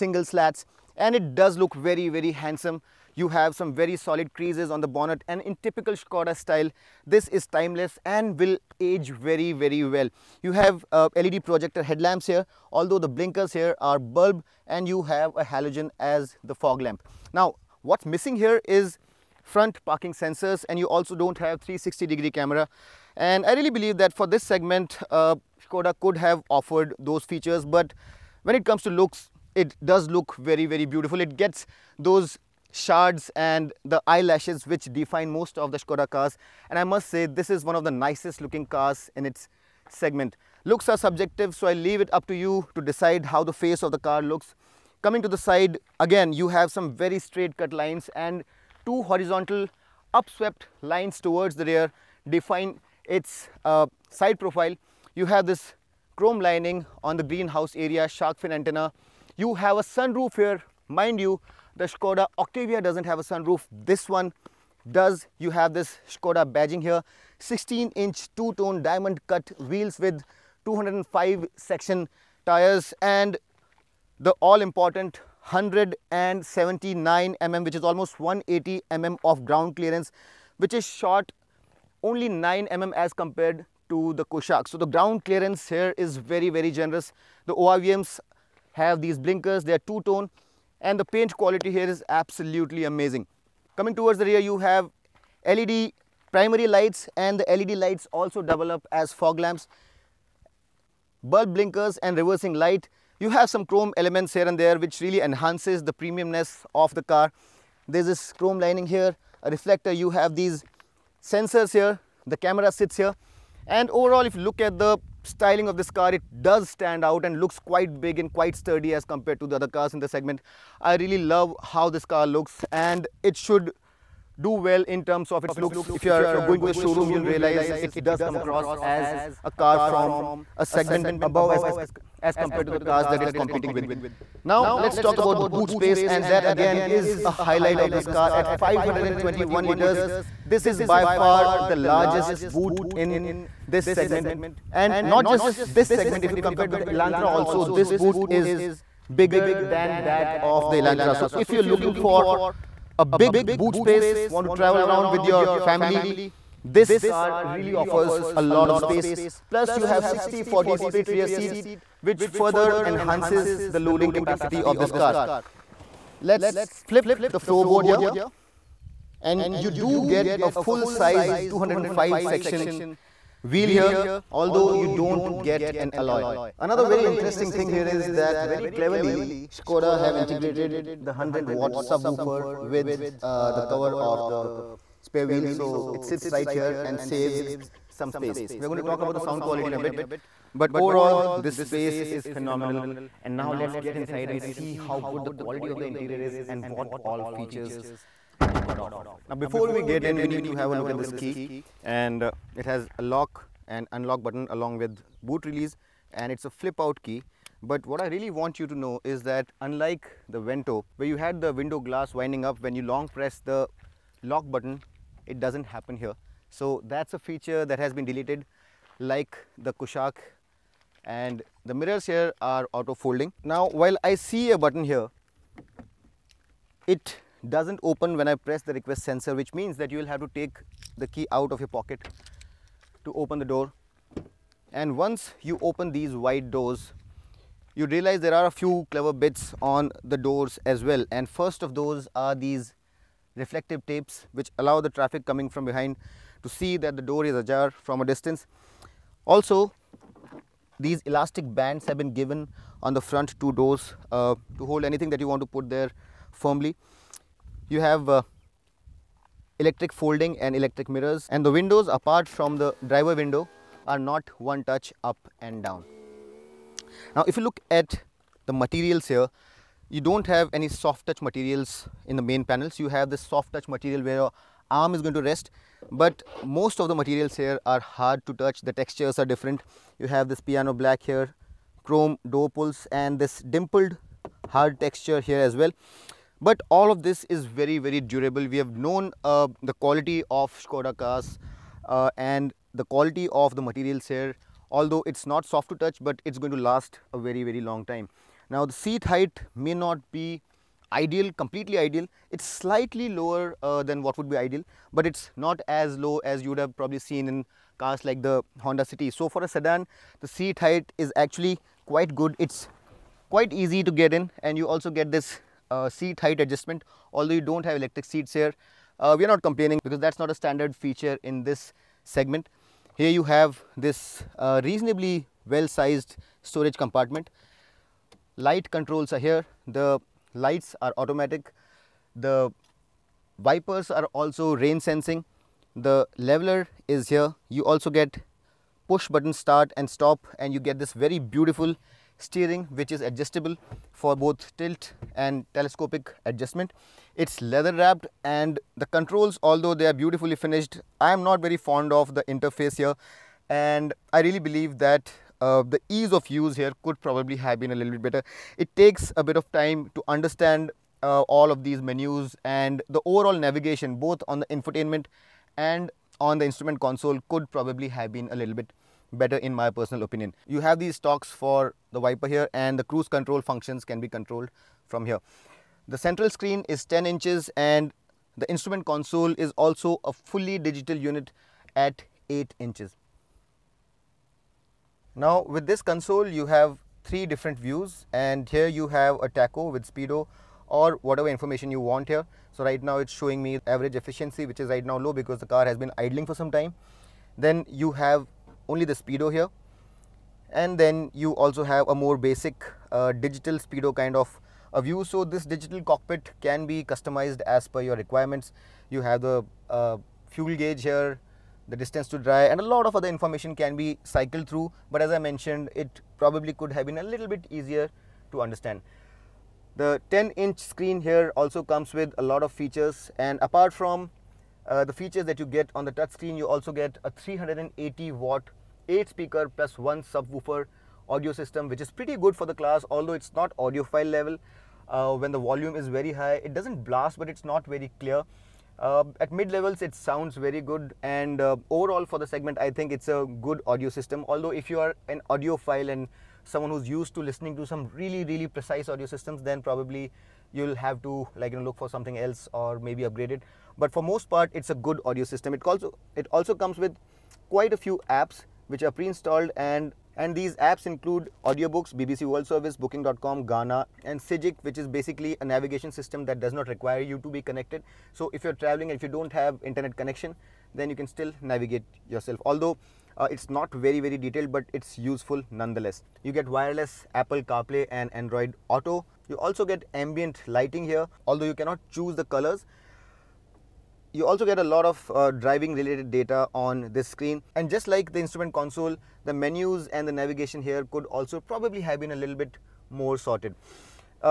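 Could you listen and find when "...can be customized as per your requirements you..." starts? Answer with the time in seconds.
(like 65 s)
406 s.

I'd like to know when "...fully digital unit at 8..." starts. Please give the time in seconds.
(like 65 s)
380 s.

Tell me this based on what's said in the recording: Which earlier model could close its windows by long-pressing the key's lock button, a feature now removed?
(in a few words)
Vento.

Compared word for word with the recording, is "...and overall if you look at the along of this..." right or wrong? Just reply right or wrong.
wrong.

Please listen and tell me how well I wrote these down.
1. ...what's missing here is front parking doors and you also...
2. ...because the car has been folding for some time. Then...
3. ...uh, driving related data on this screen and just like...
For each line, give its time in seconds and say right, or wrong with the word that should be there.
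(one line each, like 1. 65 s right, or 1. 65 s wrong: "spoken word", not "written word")
1. 17 s wrong: "sensors", not "doors"
2. 395 s wrong: "idling", not "folding"
3. 485 s right.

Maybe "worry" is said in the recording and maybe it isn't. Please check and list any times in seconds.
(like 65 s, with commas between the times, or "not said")
not said.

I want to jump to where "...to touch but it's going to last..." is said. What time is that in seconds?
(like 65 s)
295 s.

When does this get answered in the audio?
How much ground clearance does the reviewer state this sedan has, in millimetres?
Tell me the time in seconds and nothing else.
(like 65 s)
75 s.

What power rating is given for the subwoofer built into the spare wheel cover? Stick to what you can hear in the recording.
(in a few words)
100 watt.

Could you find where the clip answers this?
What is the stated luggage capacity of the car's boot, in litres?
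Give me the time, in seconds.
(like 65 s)
138 s.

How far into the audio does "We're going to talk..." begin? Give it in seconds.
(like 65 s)
188 s.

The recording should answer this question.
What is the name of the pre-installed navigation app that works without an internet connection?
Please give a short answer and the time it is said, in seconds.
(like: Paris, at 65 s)
Sygic, at 464 s.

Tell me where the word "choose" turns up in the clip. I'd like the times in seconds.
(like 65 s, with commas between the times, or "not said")
481 s.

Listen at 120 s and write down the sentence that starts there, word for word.
I really love how this car looks and it should do well in terms of its looks.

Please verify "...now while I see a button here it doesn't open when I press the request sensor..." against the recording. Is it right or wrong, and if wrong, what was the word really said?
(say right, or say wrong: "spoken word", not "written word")
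right.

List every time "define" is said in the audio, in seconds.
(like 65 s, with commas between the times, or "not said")
34 s, 52 s.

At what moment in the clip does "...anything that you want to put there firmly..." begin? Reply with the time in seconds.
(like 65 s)
254 s.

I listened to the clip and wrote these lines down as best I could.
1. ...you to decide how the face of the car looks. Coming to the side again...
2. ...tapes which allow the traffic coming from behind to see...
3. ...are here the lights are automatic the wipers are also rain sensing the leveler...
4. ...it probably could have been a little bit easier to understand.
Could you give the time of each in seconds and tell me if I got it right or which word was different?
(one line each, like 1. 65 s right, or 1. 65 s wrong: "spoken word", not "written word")
1. 42 s right
2. 243 s right
3. 329 s right
4. 415 s right.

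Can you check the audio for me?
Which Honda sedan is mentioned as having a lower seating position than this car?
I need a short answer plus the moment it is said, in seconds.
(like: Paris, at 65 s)
Honda City, at 308 s.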